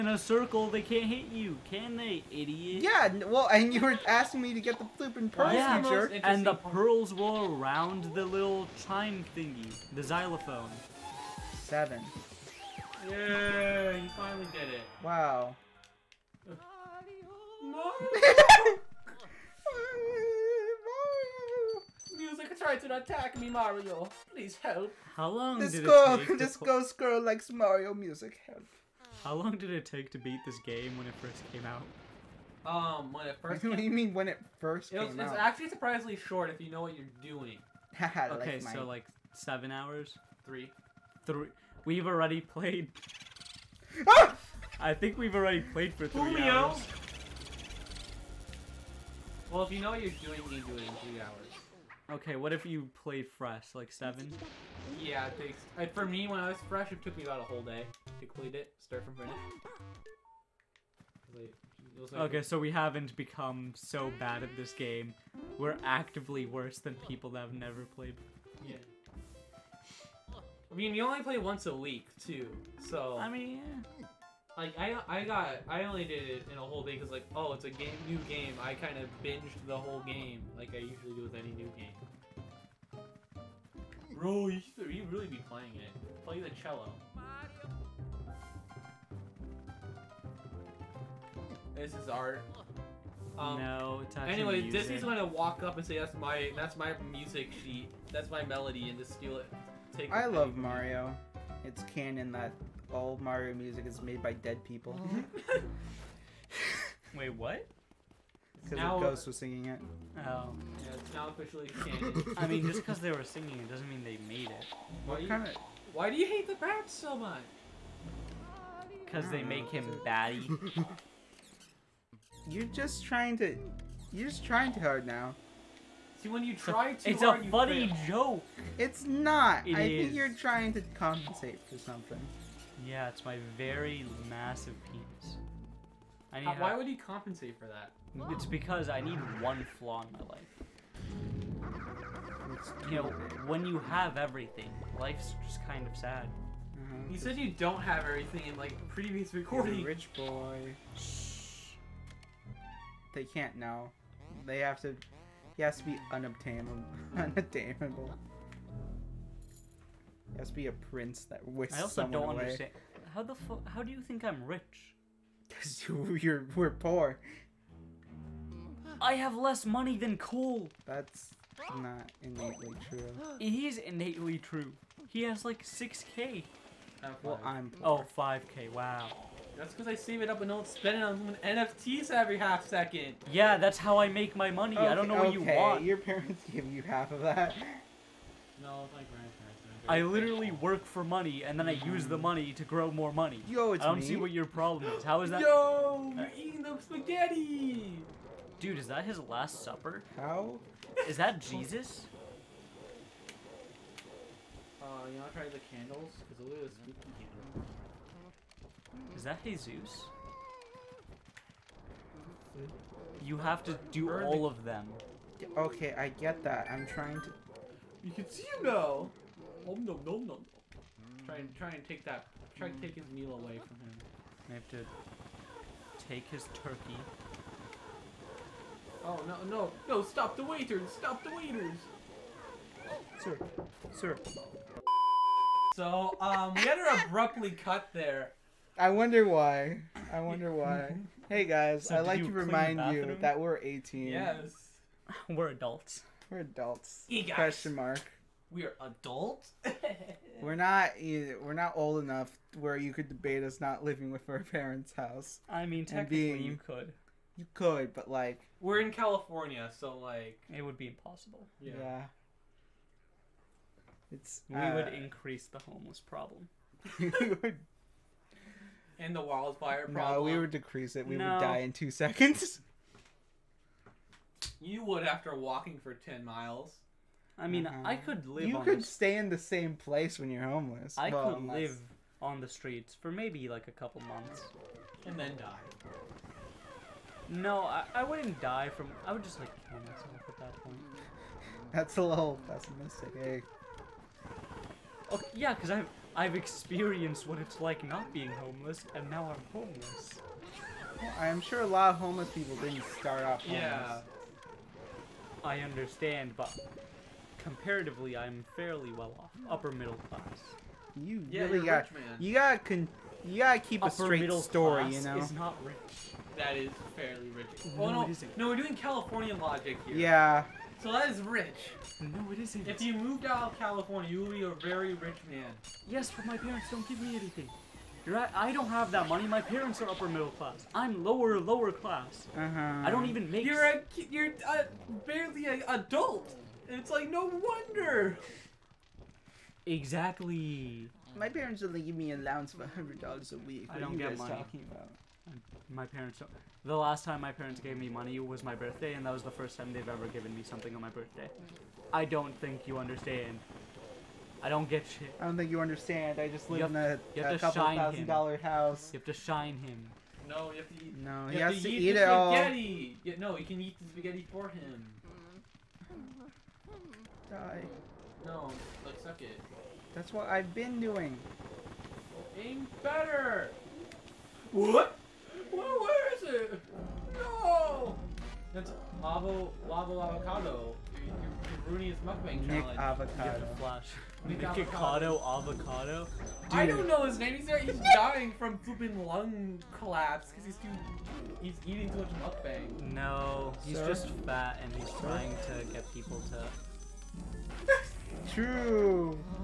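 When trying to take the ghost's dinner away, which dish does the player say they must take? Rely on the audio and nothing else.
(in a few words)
Turkey.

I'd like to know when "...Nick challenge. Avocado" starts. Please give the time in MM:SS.
06:22.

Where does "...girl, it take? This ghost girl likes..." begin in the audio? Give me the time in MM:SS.
00:25.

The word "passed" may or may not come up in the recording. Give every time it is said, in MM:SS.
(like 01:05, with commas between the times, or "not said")
not said.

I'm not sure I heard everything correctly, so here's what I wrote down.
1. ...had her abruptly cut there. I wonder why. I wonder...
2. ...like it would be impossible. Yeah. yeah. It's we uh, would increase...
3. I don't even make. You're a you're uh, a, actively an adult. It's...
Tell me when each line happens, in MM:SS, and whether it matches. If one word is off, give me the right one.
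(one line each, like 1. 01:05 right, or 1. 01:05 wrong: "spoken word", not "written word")
1. 03:56 right
2. 04:19 right
3. 05:32 wrong: "barely", not "actively".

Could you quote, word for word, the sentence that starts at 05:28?
You're I don't have that money.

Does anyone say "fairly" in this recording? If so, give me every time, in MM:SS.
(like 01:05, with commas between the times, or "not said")
05:08, 05:16.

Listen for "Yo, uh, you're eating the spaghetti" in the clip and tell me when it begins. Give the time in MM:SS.
03:15.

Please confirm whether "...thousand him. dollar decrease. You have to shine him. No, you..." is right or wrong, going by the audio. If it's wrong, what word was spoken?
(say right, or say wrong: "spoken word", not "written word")
wrong: "house", not "decrease".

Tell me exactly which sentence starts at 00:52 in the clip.
Okay, what if you played fresh, like seven?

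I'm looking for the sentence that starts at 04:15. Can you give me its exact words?
I mean, technically being, you could.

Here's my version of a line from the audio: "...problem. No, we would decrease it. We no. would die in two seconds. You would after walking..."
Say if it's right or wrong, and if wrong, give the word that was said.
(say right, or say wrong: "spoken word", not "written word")
right.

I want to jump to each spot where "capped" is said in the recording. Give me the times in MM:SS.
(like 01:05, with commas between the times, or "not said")
not said.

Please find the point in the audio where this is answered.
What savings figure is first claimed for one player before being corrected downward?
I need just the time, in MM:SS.
02:55.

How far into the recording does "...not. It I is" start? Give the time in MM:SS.
02:09.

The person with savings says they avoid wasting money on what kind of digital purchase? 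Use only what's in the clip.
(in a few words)
NFTs.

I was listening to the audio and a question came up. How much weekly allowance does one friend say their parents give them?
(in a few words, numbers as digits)
$100 a week.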